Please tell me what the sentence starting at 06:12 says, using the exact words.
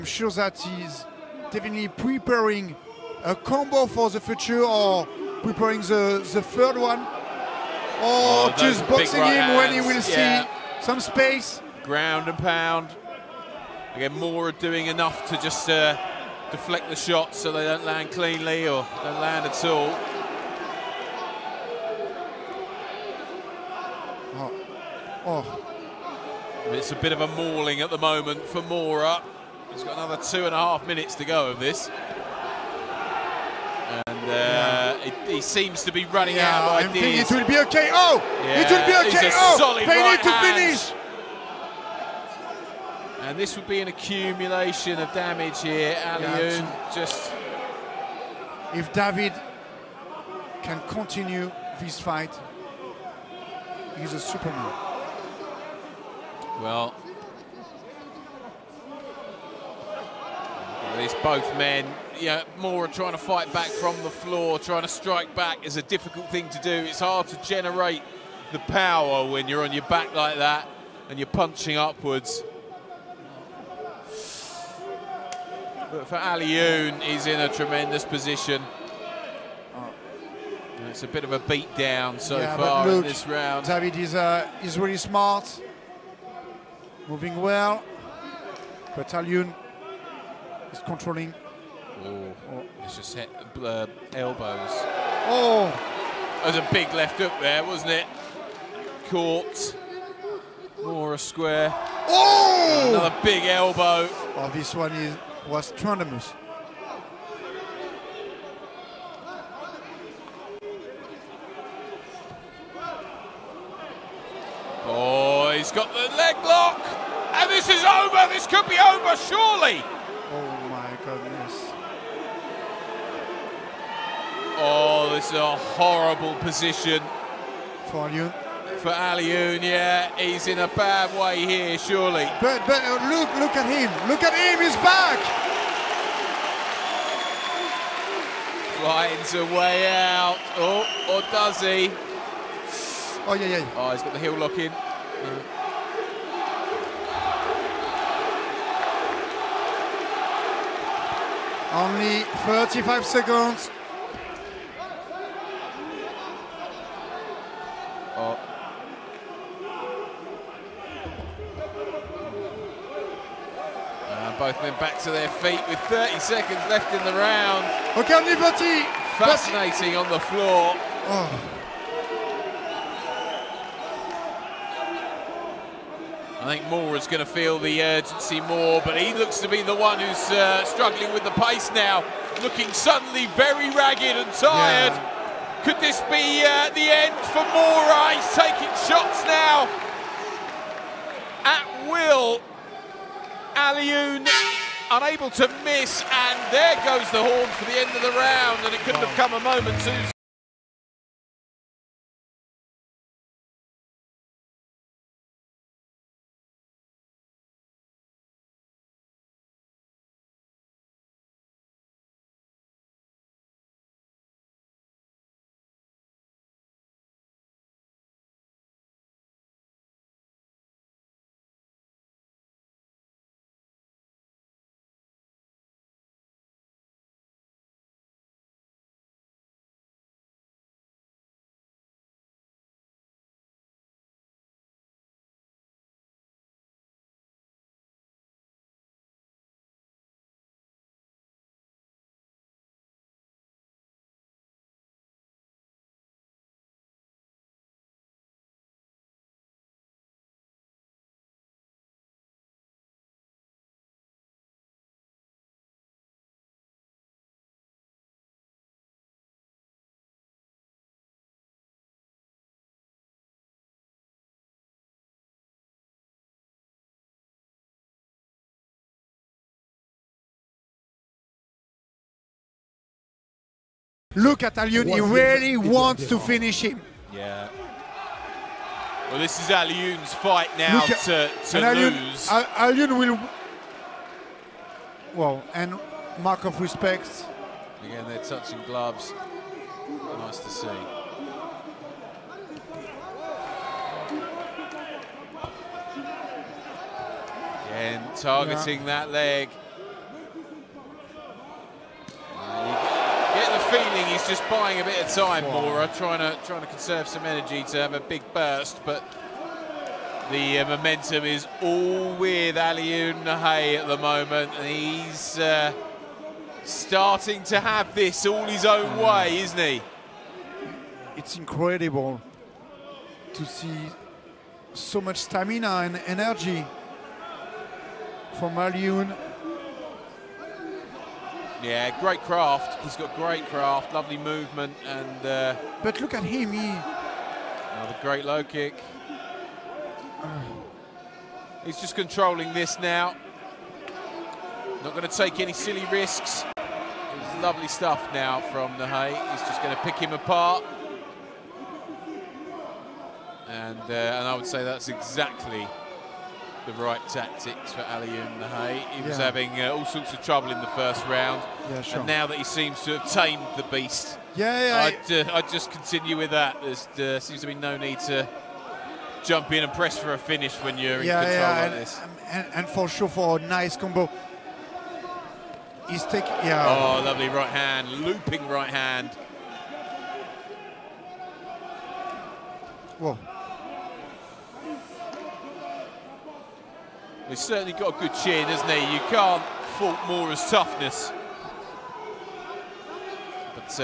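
And, and, for sure, for a nice combo.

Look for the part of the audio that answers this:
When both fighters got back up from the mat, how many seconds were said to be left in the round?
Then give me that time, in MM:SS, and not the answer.
02:45.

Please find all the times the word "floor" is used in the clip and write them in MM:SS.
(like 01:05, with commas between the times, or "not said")
01:04, 02:50.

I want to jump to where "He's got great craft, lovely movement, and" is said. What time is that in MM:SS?
05:32.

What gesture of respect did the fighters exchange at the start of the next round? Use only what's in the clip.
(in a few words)
touching gloves.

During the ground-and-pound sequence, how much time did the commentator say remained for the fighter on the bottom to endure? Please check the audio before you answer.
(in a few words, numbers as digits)
two and a half minutes.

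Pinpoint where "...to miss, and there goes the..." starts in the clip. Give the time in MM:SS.
03:15.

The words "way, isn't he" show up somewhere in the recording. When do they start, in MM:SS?
05:19.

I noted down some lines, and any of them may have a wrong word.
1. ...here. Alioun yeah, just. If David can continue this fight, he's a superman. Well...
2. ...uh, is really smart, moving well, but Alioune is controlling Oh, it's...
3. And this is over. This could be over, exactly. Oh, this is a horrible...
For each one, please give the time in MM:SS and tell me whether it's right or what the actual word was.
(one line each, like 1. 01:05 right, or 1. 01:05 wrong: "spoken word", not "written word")
1. 00:45 right
2. 01:24 right
3. 01:57 wrong: "surely", not "exactly".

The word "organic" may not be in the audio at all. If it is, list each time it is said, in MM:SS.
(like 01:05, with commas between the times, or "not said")
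not said.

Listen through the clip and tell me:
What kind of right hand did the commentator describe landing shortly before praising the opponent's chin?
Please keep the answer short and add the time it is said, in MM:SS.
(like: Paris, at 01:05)
looping right hand, at 06:18.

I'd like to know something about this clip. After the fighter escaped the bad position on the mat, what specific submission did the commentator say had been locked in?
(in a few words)
heel lock.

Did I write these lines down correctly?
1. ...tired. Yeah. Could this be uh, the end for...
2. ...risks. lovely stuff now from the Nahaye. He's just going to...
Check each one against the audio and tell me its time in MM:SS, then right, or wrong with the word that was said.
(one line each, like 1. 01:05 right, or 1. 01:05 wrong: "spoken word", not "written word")
1. 03:04 right
2. 05:45 wrong: "Hay", not "Nahaye".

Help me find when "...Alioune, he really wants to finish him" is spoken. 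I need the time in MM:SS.
04:34.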